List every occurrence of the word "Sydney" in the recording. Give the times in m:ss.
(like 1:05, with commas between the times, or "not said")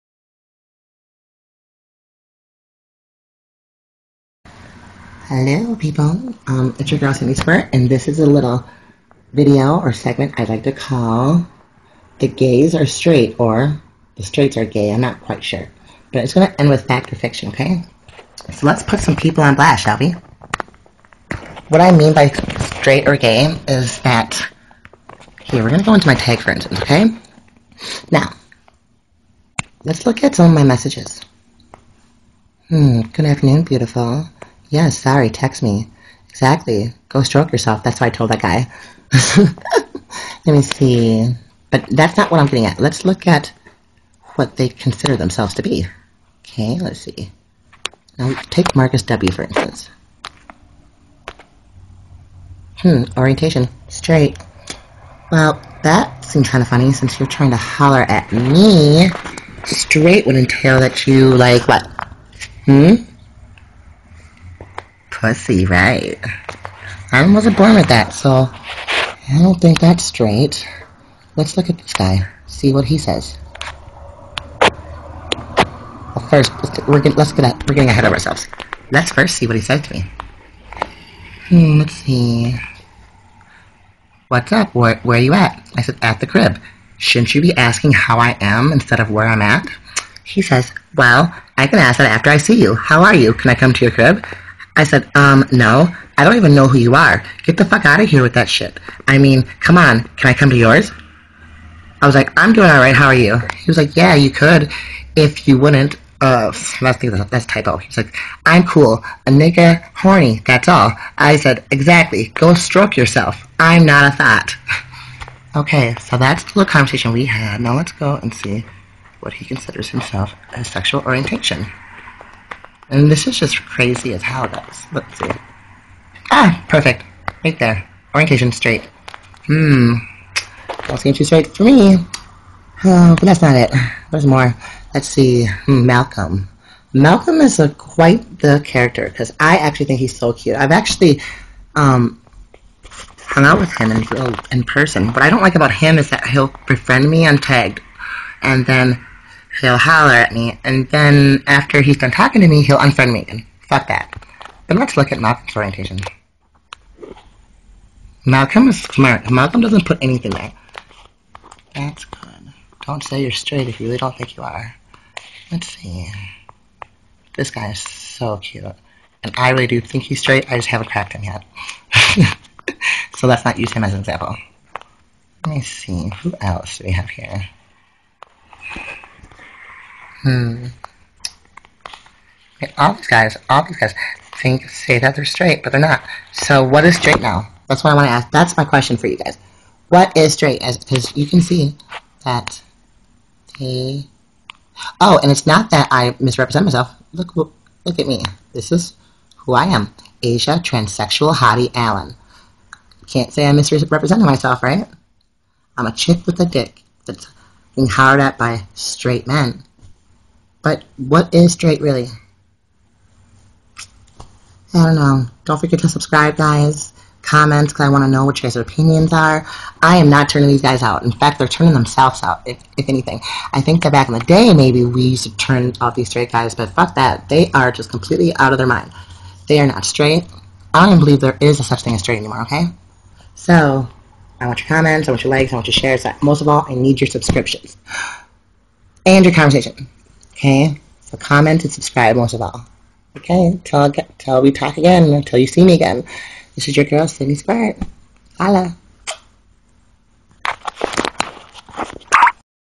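4:07.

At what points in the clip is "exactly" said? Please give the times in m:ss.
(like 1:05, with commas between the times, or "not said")
0:36, 1:51.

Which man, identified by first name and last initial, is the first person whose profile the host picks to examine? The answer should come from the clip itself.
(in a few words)
Marcus W.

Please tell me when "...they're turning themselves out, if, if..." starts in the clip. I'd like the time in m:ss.
3:41.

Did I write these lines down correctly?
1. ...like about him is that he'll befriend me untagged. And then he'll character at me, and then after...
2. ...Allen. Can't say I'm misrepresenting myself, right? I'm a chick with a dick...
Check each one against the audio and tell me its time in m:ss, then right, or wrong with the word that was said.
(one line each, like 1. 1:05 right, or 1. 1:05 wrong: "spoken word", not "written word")
1. 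2:25 wrong: "holler", not "character"
2. 3:21 right.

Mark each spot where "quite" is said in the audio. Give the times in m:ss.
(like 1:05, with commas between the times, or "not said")
0:15, 2:17.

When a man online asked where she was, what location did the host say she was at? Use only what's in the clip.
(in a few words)
at the crib.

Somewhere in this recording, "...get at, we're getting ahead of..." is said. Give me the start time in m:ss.
1:17.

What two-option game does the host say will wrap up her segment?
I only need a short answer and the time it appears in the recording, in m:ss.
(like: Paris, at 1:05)
fact or fiction, at 0:16.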